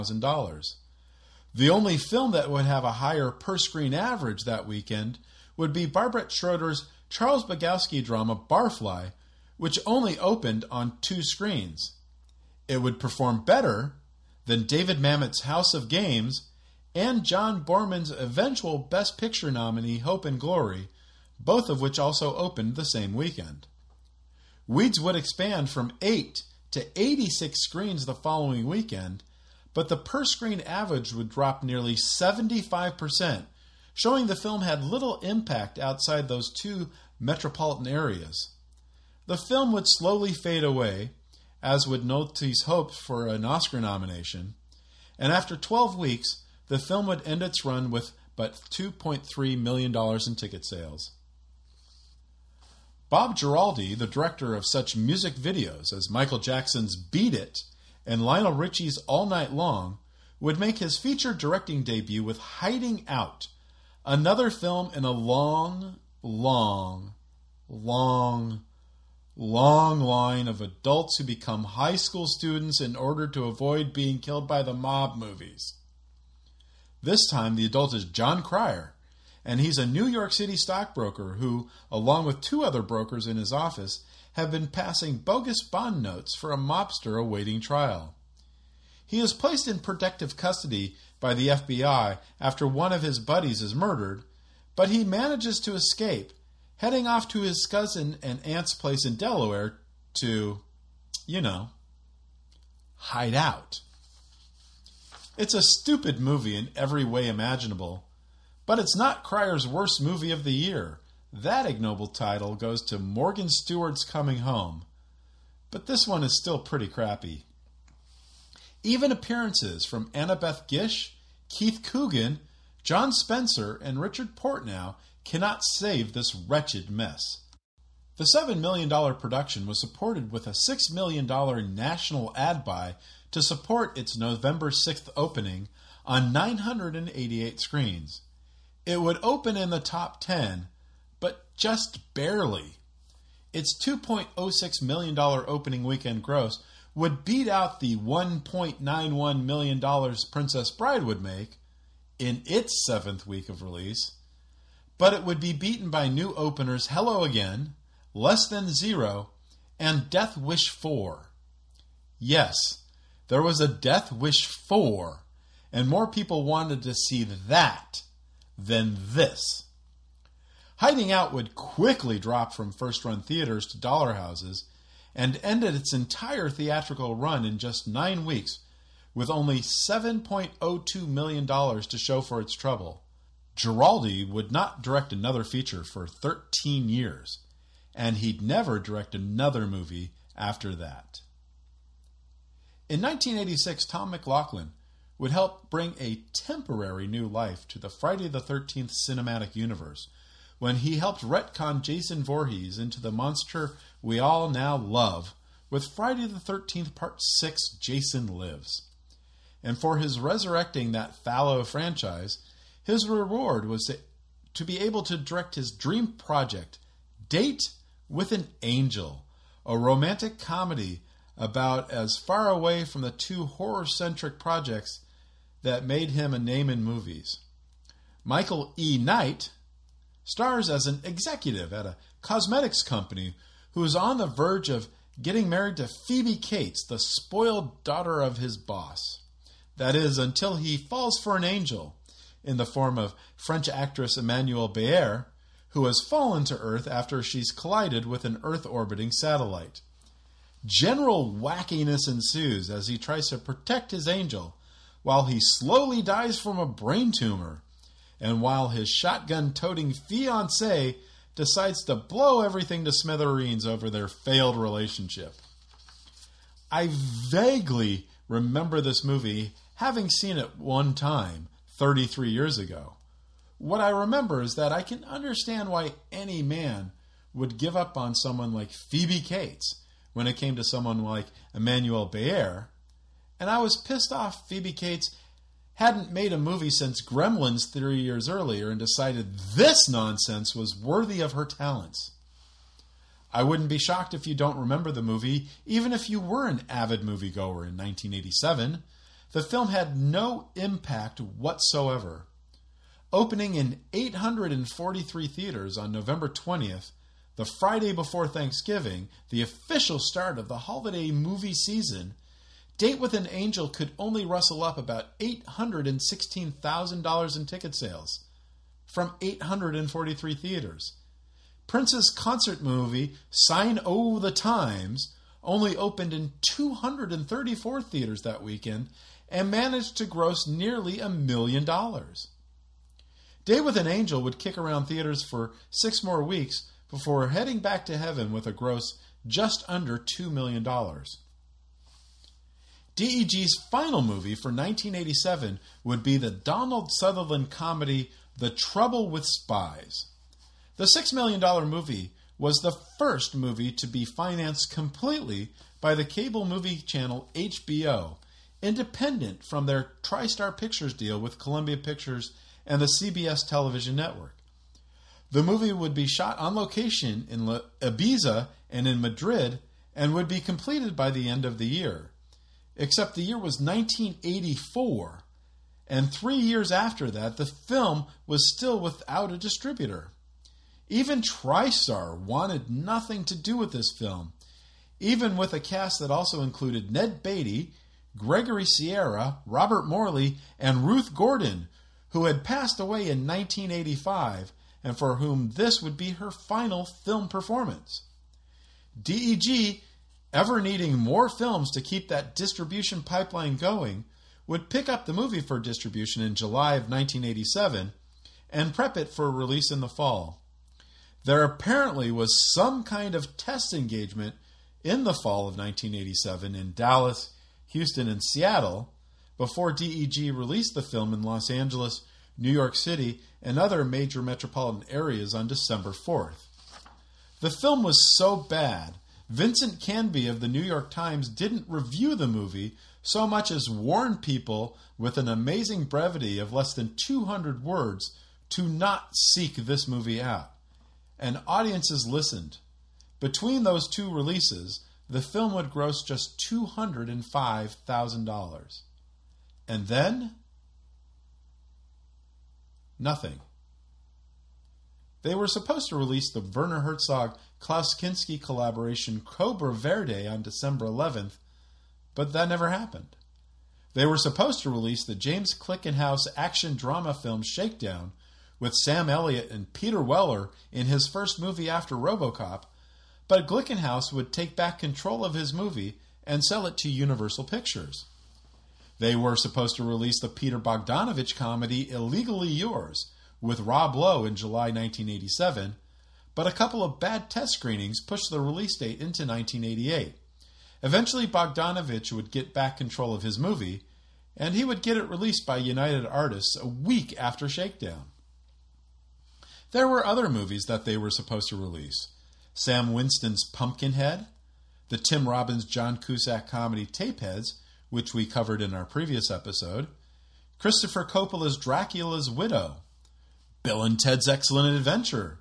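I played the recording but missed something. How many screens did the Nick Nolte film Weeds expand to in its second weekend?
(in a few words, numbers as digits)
86.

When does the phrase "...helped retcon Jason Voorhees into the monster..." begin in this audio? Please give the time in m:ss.
3:20.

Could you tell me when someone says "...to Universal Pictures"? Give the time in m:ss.
7:56.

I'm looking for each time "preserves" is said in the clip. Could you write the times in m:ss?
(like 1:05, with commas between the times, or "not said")
not said.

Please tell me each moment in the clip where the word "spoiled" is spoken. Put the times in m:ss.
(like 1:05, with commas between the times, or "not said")
3:56.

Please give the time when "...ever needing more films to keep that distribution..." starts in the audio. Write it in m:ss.
6:40.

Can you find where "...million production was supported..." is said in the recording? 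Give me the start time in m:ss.
2:08.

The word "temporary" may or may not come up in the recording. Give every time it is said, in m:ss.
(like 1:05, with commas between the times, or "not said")
3:16.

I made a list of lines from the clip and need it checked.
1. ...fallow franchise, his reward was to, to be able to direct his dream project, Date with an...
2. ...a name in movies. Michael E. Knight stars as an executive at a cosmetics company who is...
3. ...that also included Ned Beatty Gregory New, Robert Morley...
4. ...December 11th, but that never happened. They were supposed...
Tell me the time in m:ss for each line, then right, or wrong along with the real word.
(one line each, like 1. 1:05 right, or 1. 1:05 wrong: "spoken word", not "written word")
1. 3:31 right
2. 3:46 right
3. 6:25 wrong: "Sierra", not "New"
4. 7:40 right.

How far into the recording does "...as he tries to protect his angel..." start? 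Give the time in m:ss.
4:12.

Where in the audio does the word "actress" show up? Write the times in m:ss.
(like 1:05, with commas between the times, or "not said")
4:03.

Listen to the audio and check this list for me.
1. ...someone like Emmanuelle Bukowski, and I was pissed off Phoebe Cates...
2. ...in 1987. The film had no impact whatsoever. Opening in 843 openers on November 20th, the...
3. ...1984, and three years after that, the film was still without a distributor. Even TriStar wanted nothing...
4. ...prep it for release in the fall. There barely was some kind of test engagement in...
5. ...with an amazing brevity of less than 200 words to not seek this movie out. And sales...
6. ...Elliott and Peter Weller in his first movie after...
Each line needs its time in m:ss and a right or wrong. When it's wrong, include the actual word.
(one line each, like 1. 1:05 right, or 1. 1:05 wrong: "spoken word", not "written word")
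1. 4:40 wrong: "Béart", not "Bukowski"
2. 4:57 wrong: "theaters", not "openers"
3. 6:13 right
4. 6:48 wrong: "apparently", not "barely"
5. 7:14 wrong: "audiences", not "sales"
6. 7:49 right.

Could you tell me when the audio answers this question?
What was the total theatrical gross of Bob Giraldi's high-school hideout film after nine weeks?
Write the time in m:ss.
2:59.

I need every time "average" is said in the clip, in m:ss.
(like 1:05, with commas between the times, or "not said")
0:03, 0:30.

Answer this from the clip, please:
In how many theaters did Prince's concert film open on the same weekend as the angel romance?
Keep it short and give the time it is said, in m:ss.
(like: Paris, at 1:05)
234, at 5:26.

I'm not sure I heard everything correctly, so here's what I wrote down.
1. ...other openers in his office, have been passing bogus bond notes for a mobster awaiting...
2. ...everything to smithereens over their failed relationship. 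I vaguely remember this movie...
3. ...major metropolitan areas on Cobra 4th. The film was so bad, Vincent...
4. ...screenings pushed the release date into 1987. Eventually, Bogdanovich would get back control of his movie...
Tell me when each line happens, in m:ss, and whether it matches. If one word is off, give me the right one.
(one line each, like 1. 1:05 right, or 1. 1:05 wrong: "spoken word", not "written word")
1. 1:22 wrong: "brokers", not "openers"
2. 4:22 right
3. 7:03 wrong: "December", not "Cobra"
4. 8:07 wrong: "1988", not "1987".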